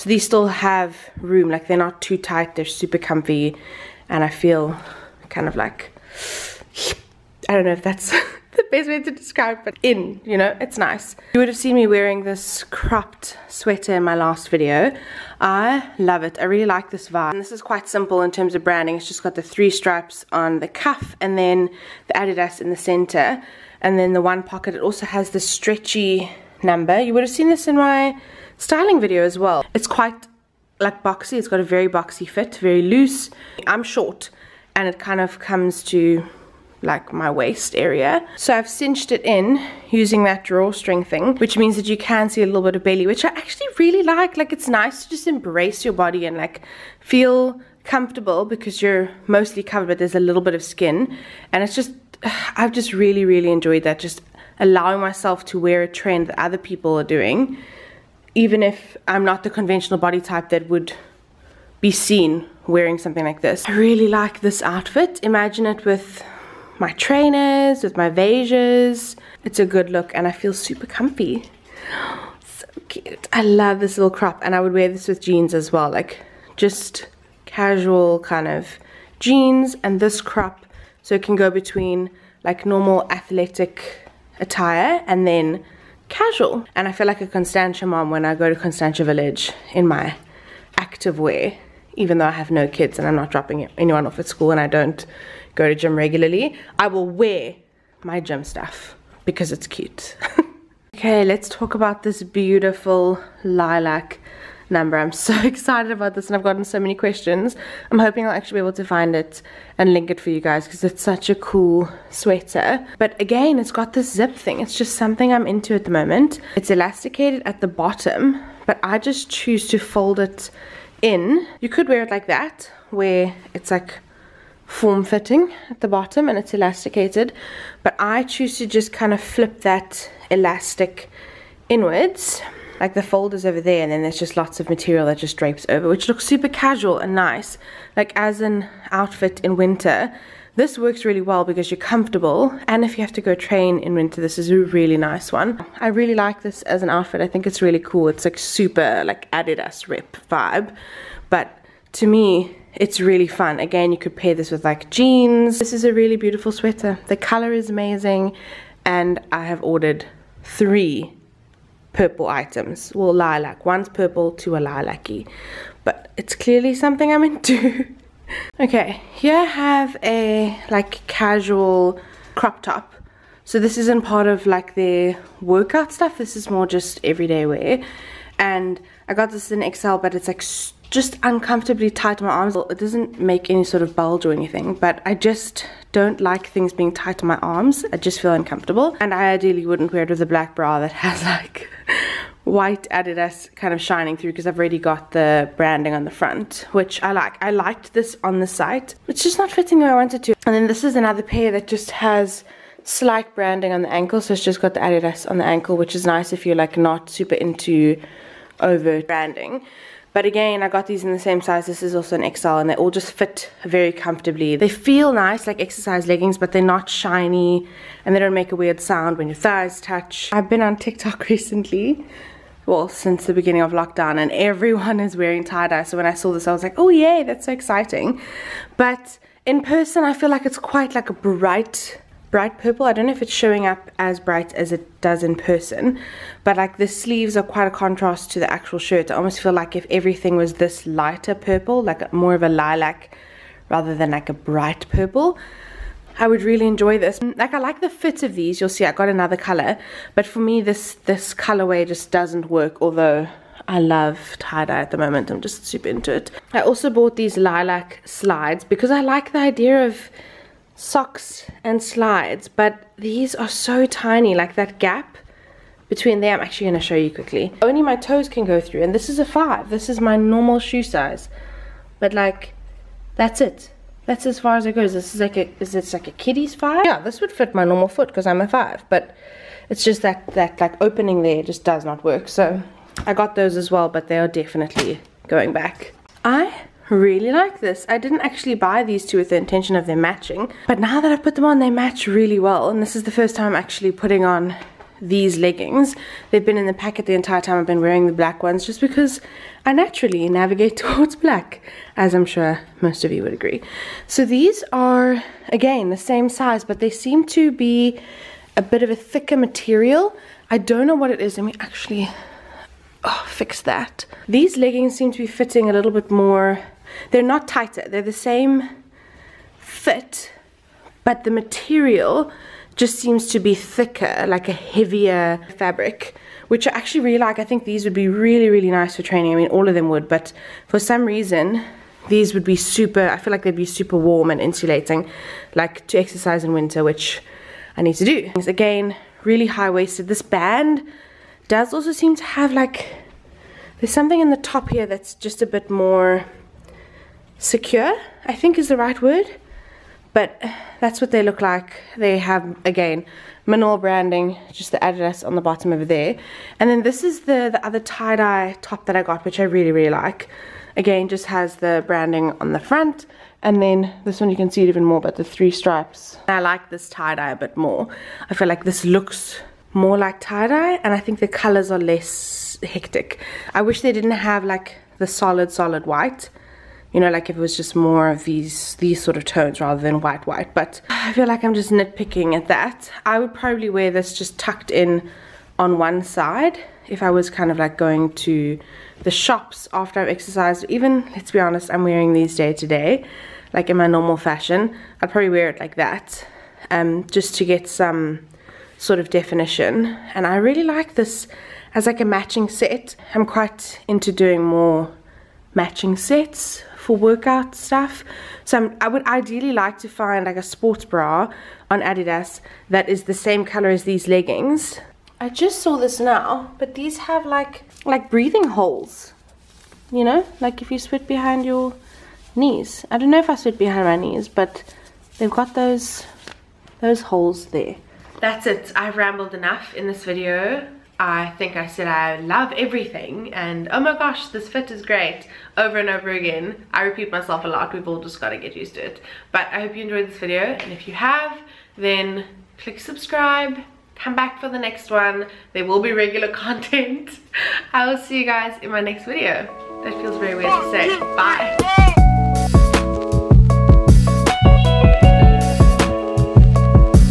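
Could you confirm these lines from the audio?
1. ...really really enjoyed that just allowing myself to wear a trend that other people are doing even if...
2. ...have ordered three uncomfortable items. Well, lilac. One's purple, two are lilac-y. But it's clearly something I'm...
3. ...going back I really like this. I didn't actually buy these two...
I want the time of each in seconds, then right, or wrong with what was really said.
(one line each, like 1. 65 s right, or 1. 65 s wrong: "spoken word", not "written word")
1. 52 s right
2. 159 s wrong: "purple", not "uncomfortable"
3. 285 s right.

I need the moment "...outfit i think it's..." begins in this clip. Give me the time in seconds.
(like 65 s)
146 s.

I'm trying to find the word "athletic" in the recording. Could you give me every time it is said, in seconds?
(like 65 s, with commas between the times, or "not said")
83 s.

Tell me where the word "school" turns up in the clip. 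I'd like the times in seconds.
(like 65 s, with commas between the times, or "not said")
94 s.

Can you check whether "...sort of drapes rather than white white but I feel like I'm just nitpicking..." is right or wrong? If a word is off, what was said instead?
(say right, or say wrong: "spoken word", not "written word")
wrong: "tones", not "drapes".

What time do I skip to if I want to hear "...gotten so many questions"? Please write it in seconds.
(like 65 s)
106 s.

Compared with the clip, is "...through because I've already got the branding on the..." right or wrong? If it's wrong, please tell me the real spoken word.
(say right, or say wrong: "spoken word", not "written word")
right.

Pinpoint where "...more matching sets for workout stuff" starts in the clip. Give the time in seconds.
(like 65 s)
404 s.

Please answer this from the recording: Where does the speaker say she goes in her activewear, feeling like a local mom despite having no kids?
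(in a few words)
Constantia Village.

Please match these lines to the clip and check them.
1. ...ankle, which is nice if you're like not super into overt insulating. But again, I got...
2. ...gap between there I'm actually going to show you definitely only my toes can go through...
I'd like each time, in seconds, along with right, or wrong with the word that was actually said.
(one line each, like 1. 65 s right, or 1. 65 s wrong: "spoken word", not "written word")
1. 205 s wrong: "branding", not "insulating"
2. 264 s wrong: "quickly", not "definitely".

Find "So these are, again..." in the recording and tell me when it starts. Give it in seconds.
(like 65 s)
304 s.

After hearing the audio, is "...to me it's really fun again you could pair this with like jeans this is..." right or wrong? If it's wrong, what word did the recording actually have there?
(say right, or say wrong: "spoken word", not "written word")
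right.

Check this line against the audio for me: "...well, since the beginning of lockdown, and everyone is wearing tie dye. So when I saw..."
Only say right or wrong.
right.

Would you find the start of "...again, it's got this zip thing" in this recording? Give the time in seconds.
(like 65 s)
113 s.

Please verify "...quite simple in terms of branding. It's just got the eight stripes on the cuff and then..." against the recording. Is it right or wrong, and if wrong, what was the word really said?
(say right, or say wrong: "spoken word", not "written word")
wrong: "three", not "eight".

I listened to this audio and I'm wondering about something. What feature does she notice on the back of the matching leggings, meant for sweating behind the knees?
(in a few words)
Breathing holes.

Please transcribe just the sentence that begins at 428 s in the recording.
I've rambled enough in this video.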